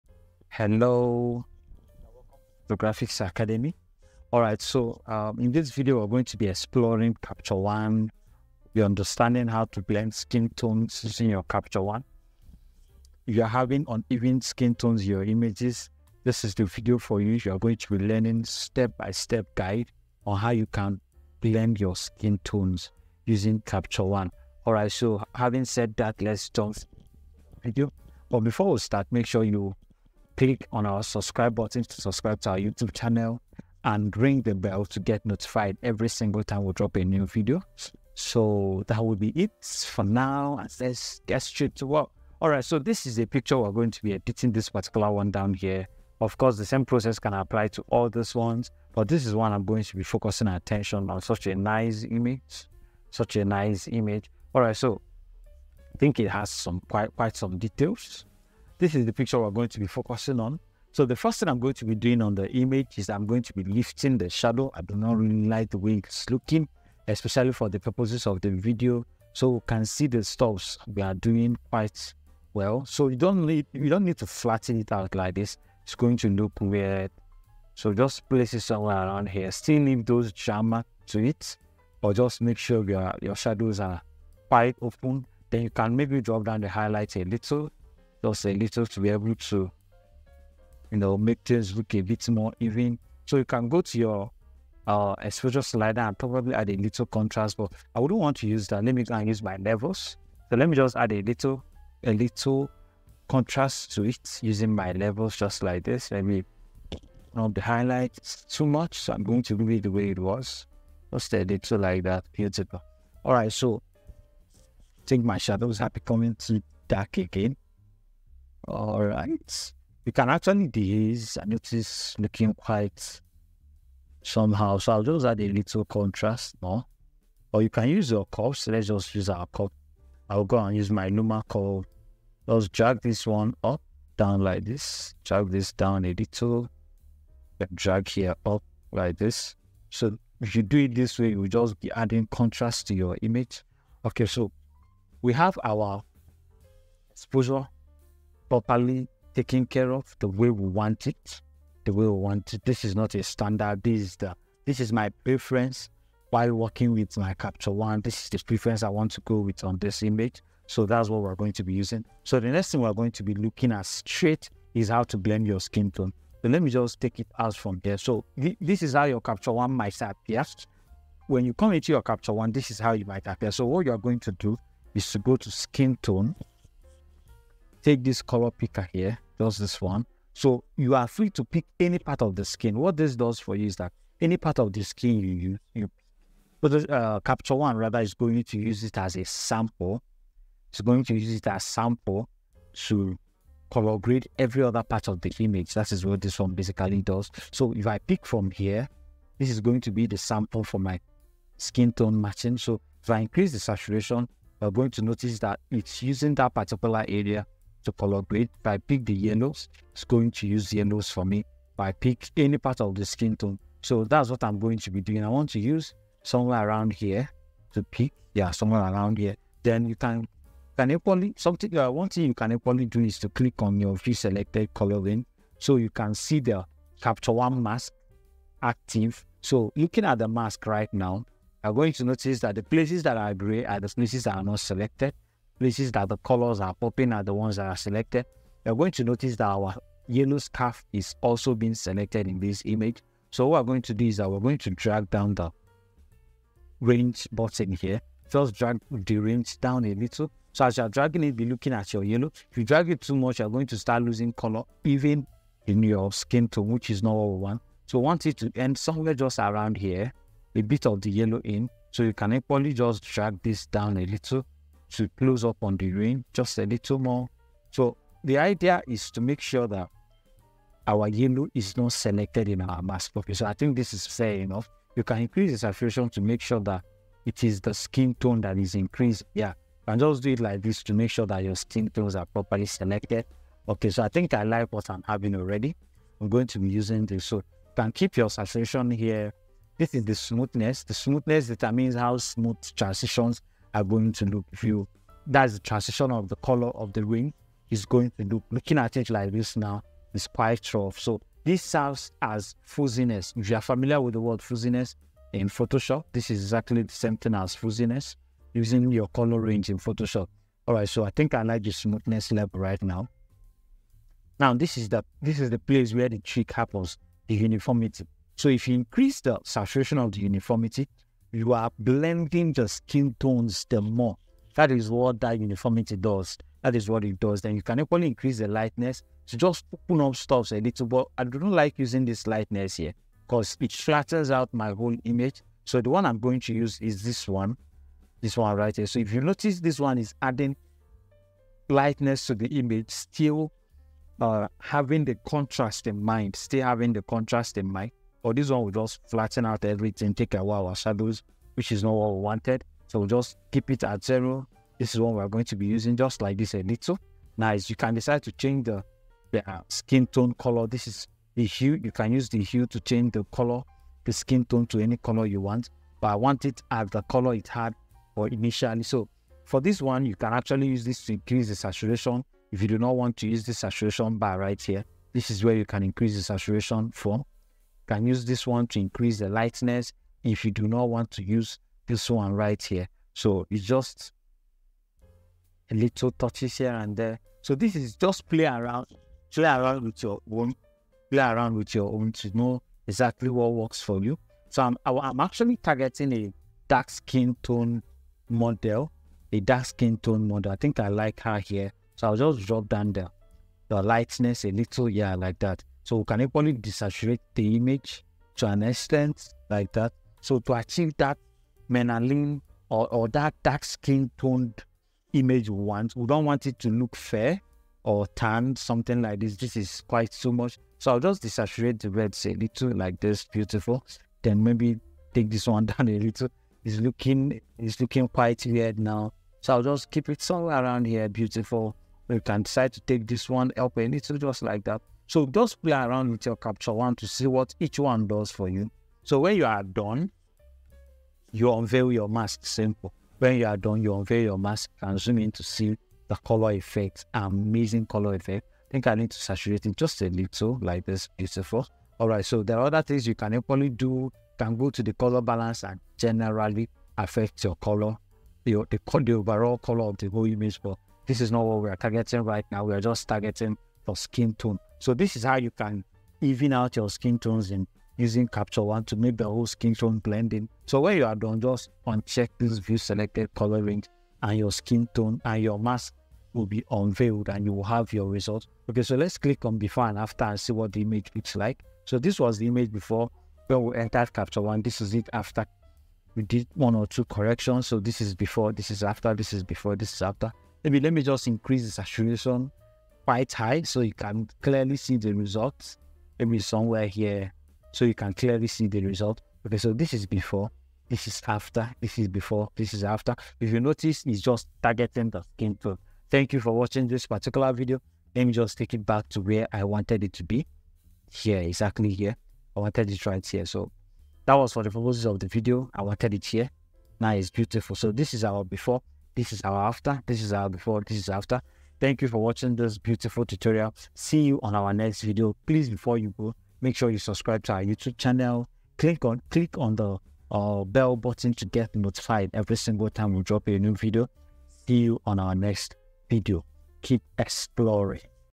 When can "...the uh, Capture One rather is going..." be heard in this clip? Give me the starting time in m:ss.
3:06.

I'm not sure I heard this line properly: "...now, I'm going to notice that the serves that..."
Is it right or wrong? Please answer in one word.
wrong.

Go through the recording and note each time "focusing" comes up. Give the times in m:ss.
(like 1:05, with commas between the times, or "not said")
0:50, 0:59.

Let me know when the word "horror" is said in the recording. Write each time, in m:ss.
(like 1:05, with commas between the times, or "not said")
not said.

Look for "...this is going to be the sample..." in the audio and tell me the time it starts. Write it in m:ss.
3:19.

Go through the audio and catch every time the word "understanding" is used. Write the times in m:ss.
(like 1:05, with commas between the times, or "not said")
0:08.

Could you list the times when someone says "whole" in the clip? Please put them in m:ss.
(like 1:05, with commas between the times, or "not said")
5:34, 7:40, 7:49.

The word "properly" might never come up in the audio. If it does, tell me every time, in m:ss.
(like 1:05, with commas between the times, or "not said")
2:28, 4:42.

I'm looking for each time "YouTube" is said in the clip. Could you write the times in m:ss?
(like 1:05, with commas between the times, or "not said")
0:32, 8:47.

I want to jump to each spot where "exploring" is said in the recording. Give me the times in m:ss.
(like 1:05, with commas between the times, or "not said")
0:06, 8:57.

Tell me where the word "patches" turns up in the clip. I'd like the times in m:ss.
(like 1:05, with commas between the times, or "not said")
not said.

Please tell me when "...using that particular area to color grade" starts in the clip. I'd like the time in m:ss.
3:26.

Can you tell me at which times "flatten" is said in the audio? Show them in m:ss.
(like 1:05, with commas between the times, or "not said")
1:14, 5:33, 5:49.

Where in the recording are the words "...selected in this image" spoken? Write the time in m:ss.
4:01.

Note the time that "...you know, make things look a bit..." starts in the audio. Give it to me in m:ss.
1:30.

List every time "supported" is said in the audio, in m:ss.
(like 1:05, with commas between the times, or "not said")
not said.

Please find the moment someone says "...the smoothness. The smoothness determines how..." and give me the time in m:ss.
4:50.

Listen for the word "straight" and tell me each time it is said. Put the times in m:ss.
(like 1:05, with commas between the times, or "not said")
0:41, 2:43.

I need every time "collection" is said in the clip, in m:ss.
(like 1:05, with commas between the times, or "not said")
not said.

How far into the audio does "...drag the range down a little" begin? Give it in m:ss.
4:08.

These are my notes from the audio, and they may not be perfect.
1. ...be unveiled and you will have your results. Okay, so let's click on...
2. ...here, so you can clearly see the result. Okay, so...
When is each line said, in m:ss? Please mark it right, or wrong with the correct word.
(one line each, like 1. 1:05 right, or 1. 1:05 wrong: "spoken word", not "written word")
1. 7:56 right
2. 8:16 right.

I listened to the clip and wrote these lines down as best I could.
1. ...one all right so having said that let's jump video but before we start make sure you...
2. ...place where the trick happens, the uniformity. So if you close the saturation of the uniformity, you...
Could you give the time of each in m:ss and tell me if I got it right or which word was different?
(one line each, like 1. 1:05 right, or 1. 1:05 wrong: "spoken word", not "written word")
1. 0:24 right
2. 5:15 wrong: "increase", not "close".